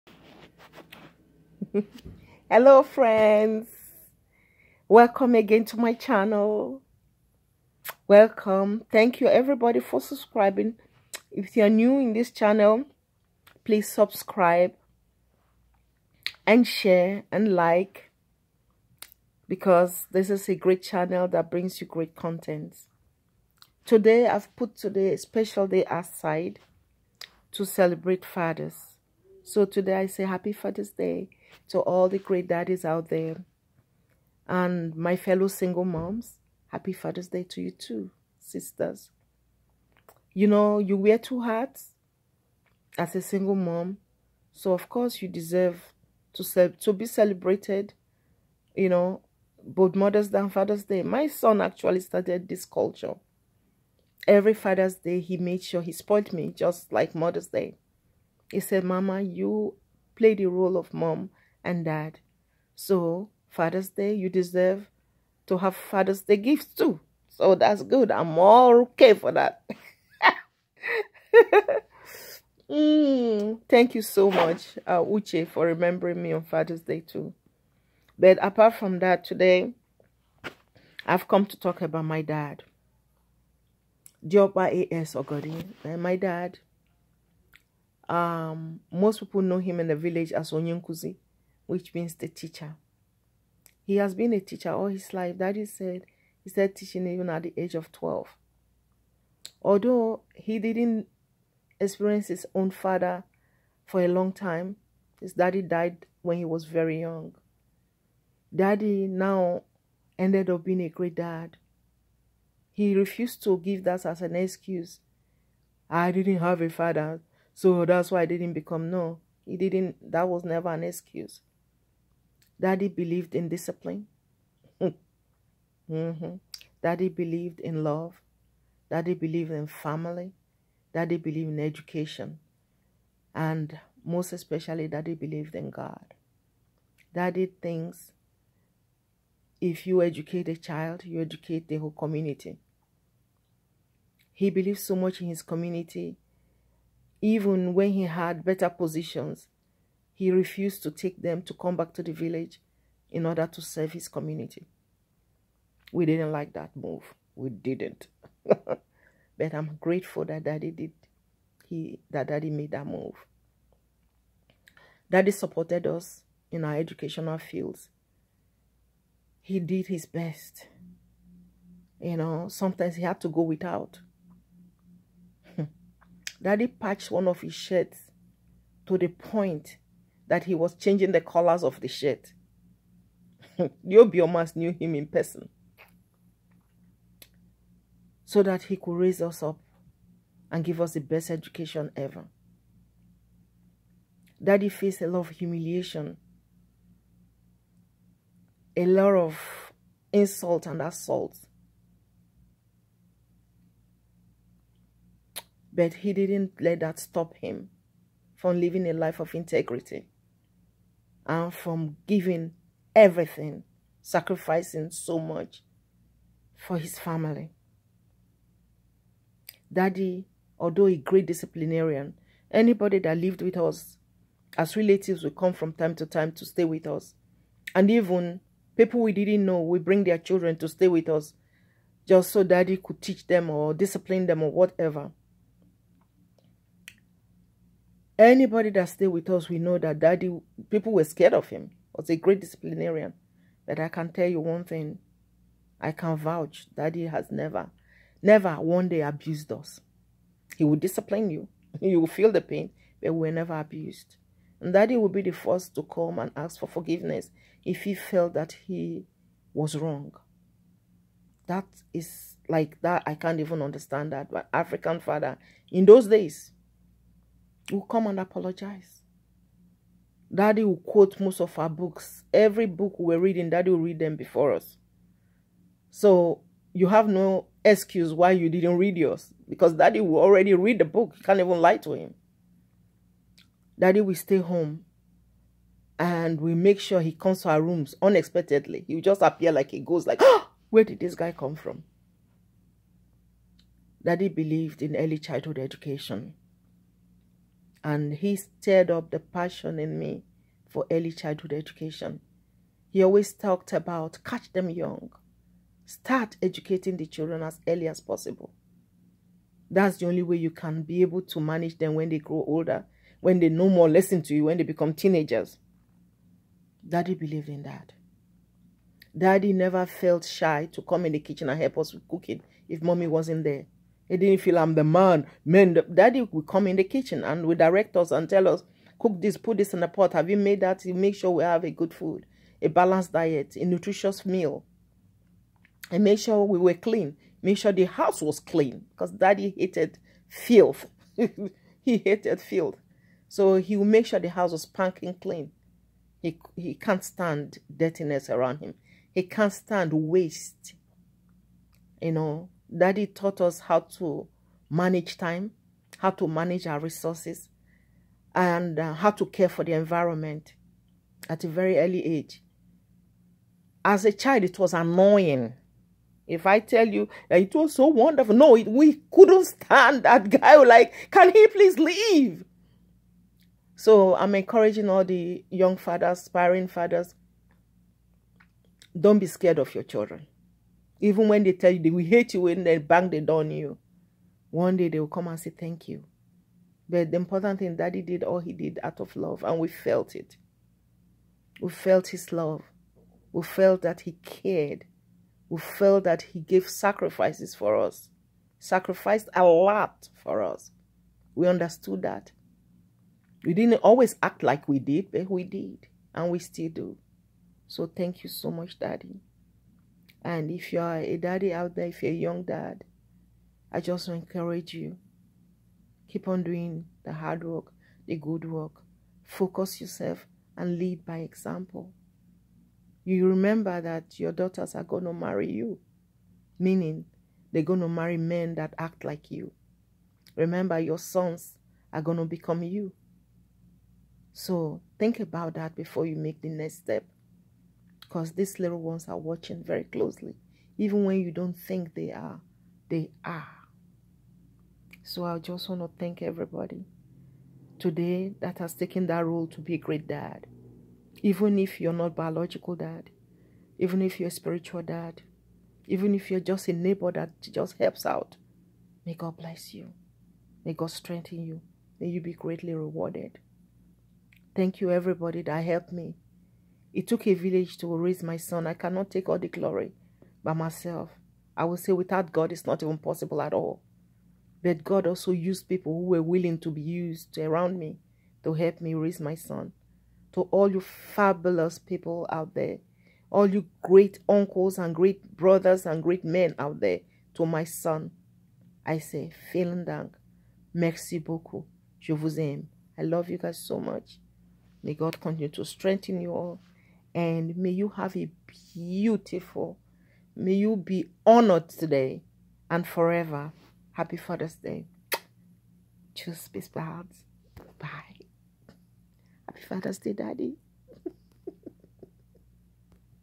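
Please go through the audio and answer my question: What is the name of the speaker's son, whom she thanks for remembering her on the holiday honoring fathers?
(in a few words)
Uche.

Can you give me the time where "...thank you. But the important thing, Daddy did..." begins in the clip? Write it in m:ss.
6:25.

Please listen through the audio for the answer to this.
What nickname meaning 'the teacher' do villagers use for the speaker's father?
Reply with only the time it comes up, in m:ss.
1:30.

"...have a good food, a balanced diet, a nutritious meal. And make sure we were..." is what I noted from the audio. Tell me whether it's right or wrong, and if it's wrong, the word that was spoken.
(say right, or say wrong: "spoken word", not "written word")
right.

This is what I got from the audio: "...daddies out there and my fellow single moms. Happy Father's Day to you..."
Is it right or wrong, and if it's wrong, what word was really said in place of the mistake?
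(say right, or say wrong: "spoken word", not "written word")
right.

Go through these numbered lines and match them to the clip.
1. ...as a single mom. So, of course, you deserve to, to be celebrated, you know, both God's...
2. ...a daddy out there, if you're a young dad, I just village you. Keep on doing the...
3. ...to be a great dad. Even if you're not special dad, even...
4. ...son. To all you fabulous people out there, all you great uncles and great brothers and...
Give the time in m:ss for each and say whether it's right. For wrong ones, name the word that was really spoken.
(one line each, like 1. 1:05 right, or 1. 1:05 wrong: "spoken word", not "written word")
1. 0:42 wrong: "Mother", not "God"
2. 6:50 wrong: "encourage", not "village"
3. 7:29 wrong: "biological", not "special"
4. 7:59 right.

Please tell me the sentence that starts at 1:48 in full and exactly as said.
Daddy now ended up being a great dad.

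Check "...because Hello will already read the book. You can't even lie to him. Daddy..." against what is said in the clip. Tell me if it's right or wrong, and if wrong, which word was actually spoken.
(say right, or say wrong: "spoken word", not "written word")
wrong: "Daddy", not "Hello".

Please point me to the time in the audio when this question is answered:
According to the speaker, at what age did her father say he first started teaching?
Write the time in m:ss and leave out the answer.
1:37.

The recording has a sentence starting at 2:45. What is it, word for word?
Daddy supported us in our educational fields.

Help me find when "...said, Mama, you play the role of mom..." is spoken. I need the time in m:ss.
0:58.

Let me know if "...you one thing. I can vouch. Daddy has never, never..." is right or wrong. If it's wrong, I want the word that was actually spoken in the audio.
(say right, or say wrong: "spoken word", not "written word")
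right.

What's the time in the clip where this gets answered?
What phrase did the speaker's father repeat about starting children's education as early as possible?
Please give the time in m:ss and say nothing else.
5:04.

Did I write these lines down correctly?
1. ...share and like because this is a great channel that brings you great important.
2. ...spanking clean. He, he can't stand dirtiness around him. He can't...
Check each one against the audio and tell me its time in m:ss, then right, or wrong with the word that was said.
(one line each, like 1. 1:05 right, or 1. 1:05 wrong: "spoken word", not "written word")
1. 0:16 wrong: "content", not "important"
2. 5:44 right.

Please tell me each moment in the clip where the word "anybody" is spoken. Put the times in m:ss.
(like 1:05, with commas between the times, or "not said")
3:42, 3:58.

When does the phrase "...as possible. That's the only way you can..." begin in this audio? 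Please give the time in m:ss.
5:07.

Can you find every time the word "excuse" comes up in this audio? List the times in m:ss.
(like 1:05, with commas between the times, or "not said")
1:54, 2:00, 4:37.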